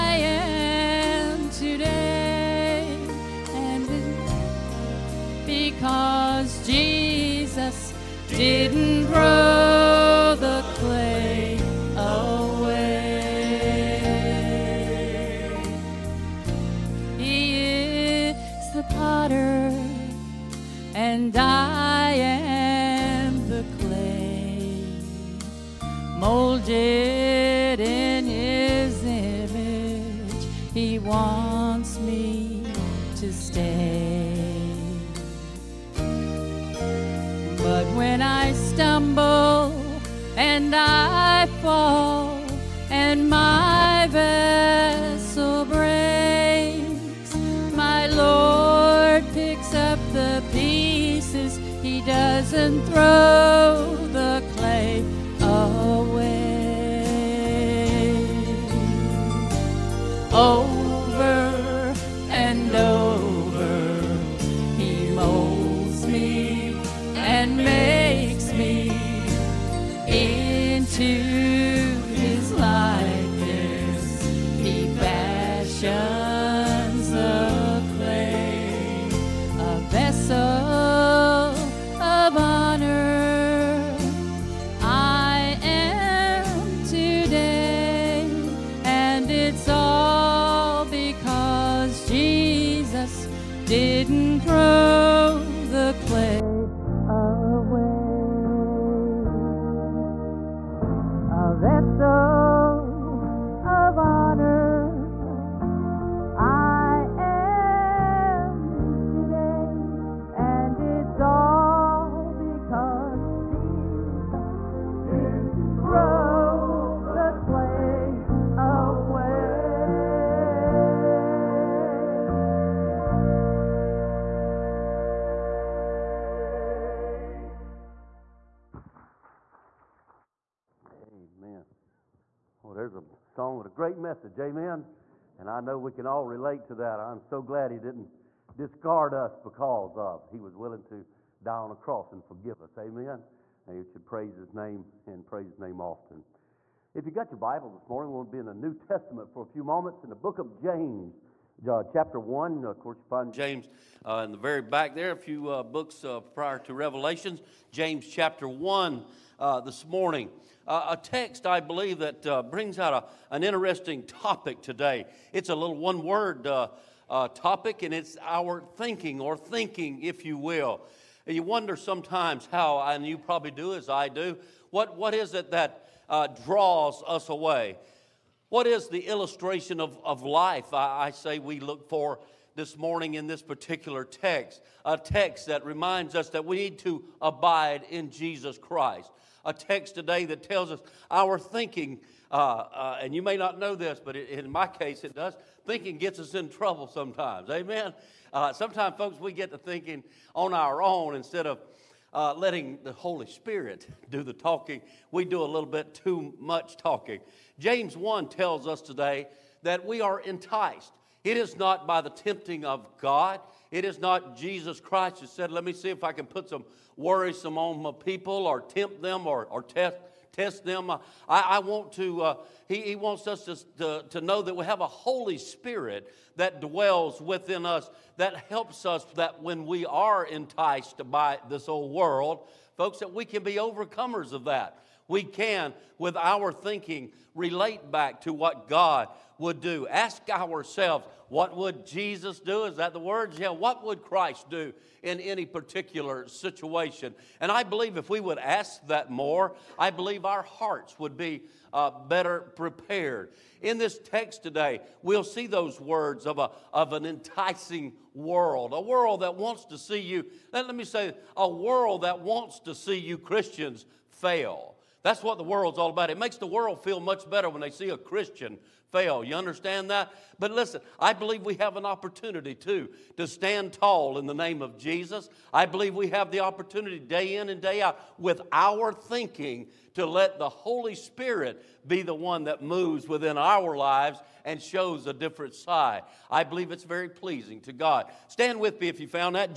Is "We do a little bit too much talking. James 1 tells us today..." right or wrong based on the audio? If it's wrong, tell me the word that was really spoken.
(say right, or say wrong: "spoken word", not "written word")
right.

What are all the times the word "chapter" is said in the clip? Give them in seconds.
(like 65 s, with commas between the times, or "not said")
151 s, 158 s.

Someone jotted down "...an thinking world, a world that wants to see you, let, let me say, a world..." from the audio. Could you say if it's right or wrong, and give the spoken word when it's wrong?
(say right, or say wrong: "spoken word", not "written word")
wrong: "enticing", not "thinking".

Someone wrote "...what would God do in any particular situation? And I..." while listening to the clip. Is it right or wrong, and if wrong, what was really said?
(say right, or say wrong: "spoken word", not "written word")
wrong: "Christ", not "God".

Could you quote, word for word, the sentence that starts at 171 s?
And you wonder sometimes how, and you probably do as I do, what, what is it that uh, draws us away?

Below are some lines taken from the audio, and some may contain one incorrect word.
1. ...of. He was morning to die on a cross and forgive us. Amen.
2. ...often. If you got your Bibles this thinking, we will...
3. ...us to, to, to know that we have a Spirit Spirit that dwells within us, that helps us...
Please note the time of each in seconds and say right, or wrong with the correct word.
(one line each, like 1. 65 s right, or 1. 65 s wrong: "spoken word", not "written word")
1. 139 s wrong: "willing", not "morning"
2. 145 s wrong: "morning", not "thinking"
3. 223 s wrong: "Holy", not "Spirit".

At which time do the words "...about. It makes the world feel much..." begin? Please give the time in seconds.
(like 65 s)
265 s.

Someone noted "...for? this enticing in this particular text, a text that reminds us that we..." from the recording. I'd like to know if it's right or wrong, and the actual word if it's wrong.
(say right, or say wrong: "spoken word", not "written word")
wrong: "morning", not "enticing".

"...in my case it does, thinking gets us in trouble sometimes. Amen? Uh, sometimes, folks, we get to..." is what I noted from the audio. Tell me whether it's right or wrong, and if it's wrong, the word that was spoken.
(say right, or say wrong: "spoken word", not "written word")
right.